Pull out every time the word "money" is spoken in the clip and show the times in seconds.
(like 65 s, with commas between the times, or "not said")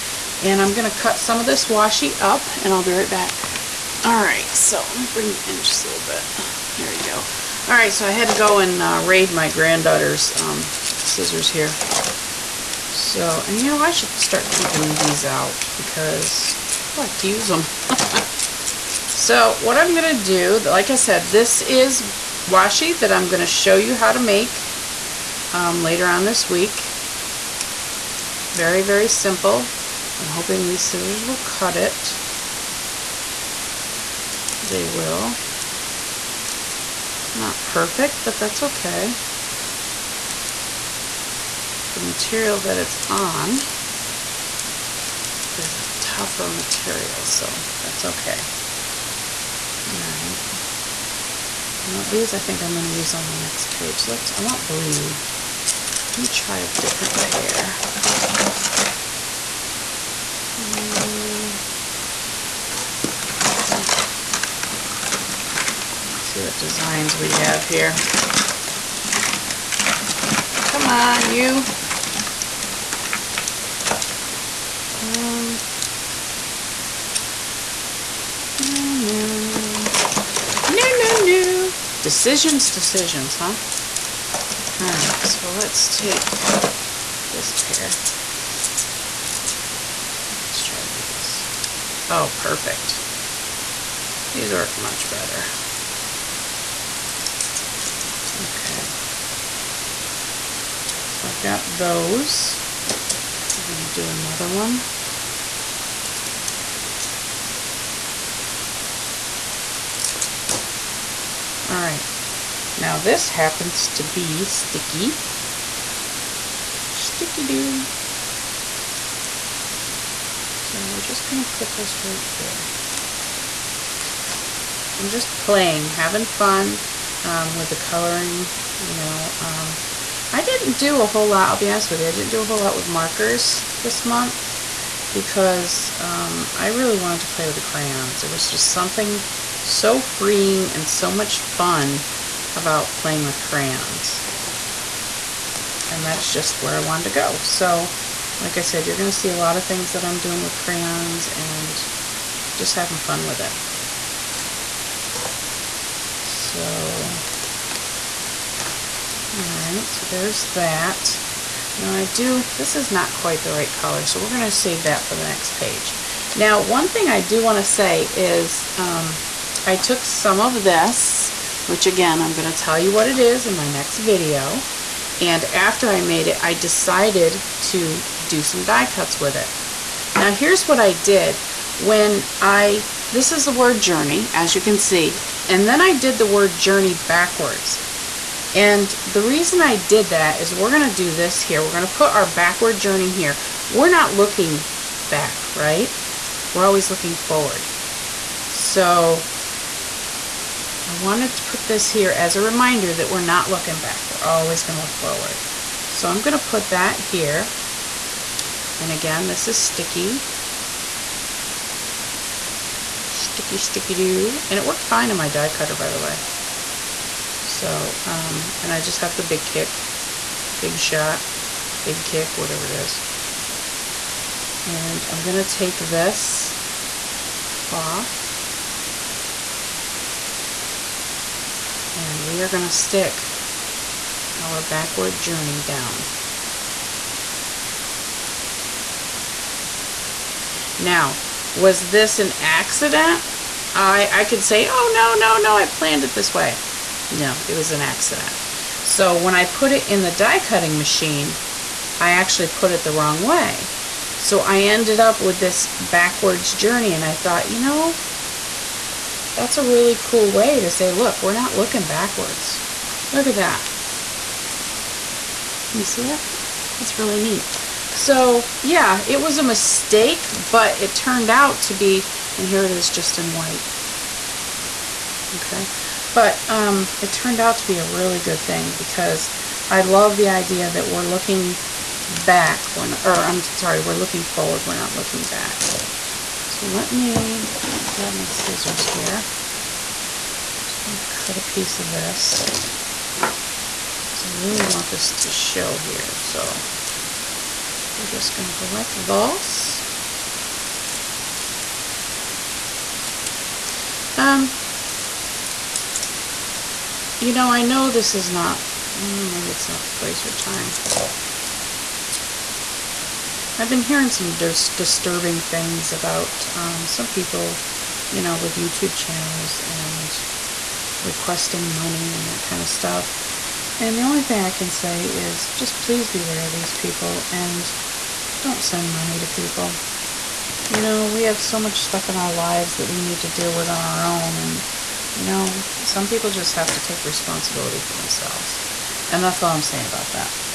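321 s, 328 s.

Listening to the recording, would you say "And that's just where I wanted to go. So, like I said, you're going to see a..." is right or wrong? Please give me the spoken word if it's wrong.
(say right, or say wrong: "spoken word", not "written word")
right.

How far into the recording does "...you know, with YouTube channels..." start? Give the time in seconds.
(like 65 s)
318 s.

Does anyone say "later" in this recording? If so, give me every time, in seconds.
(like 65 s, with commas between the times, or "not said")
25 s.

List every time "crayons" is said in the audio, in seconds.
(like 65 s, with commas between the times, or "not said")
137 s, 143 s, 150 s.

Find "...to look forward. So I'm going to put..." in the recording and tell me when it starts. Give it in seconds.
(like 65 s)
204 s.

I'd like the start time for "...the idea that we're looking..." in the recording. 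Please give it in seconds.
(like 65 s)
280 s.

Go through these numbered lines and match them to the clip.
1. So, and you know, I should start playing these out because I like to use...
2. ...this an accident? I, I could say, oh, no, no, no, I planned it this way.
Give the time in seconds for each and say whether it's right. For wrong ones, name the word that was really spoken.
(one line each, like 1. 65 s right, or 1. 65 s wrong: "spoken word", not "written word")
1. 12 s wrong: "keeping", not "playing"
2. 241 s right.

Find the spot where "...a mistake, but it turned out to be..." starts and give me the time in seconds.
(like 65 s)
269 s.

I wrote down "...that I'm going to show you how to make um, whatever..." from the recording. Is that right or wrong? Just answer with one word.
wrong.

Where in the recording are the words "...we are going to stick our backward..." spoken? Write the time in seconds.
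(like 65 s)
232 s.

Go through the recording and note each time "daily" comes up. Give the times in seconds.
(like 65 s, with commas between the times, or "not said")
not said.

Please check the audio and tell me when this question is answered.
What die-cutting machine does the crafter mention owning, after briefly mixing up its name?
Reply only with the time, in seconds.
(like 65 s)
220 s.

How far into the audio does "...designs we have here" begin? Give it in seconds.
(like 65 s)
66 s.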